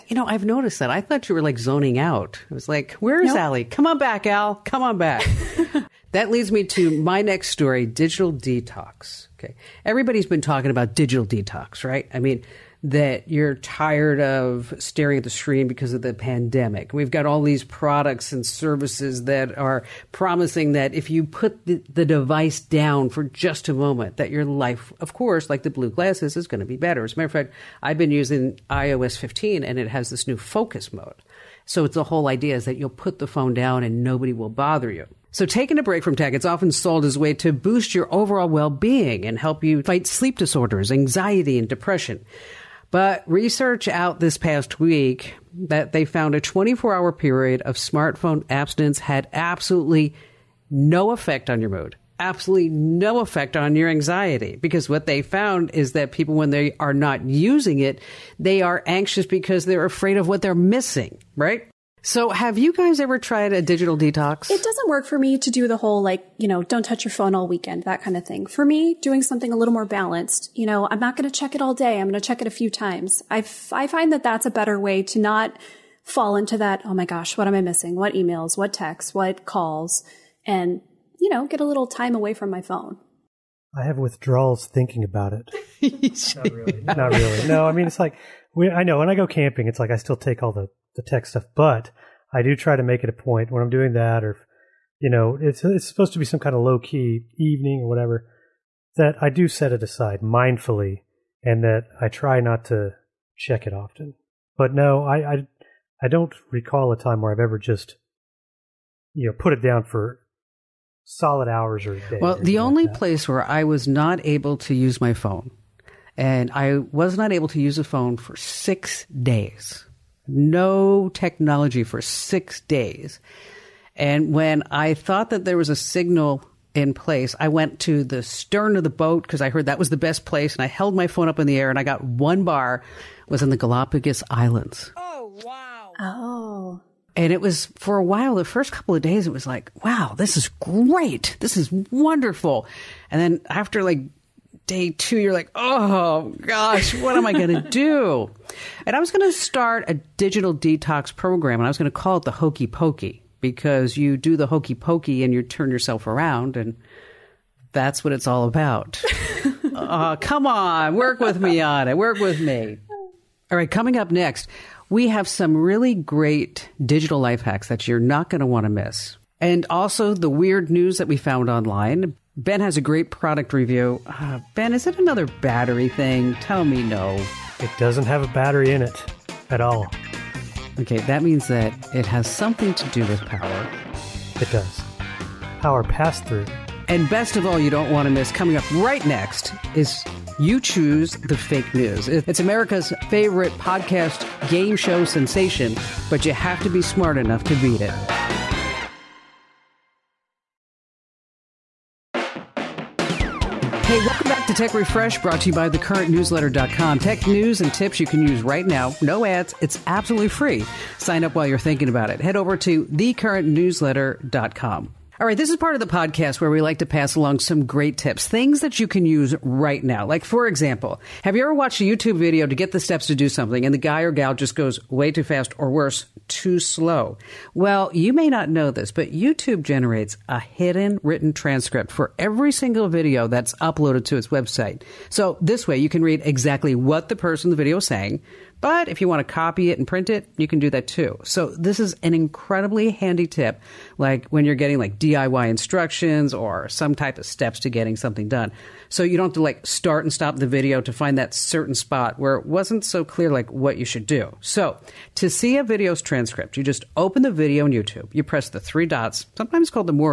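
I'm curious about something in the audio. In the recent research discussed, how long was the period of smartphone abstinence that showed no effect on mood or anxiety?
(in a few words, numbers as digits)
24 hours.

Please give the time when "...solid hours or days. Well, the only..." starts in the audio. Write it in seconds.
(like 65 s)
111 s.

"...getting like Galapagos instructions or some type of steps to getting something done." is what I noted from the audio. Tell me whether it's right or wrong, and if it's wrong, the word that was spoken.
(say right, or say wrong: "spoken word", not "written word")
wrong: "DIY", not "Galapagos".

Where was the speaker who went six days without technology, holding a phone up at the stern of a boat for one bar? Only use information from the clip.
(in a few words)
Galapagos Islands.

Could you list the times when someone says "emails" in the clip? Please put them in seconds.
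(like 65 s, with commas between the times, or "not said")
78 s.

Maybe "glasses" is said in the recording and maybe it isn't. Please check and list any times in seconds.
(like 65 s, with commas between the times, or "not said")
25 s.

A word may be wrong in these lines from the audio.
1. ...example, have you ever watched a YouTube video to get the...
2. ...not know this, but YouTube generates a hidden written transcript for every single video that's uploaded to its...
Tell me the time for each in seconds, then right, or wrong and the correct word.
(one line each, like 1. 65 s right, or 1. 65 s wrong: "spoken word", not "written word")
1. 220 s right
2. 228 s right.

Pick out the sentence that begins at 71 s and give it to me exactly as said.
I'm going to check it a few times.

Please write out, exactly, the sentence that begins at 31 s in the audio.
So it's the whole idea is that you'll put the phone down and nobody will bother you.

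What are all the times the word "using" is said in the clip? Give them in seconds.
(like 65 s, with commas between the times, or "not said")
28 s, 57 s.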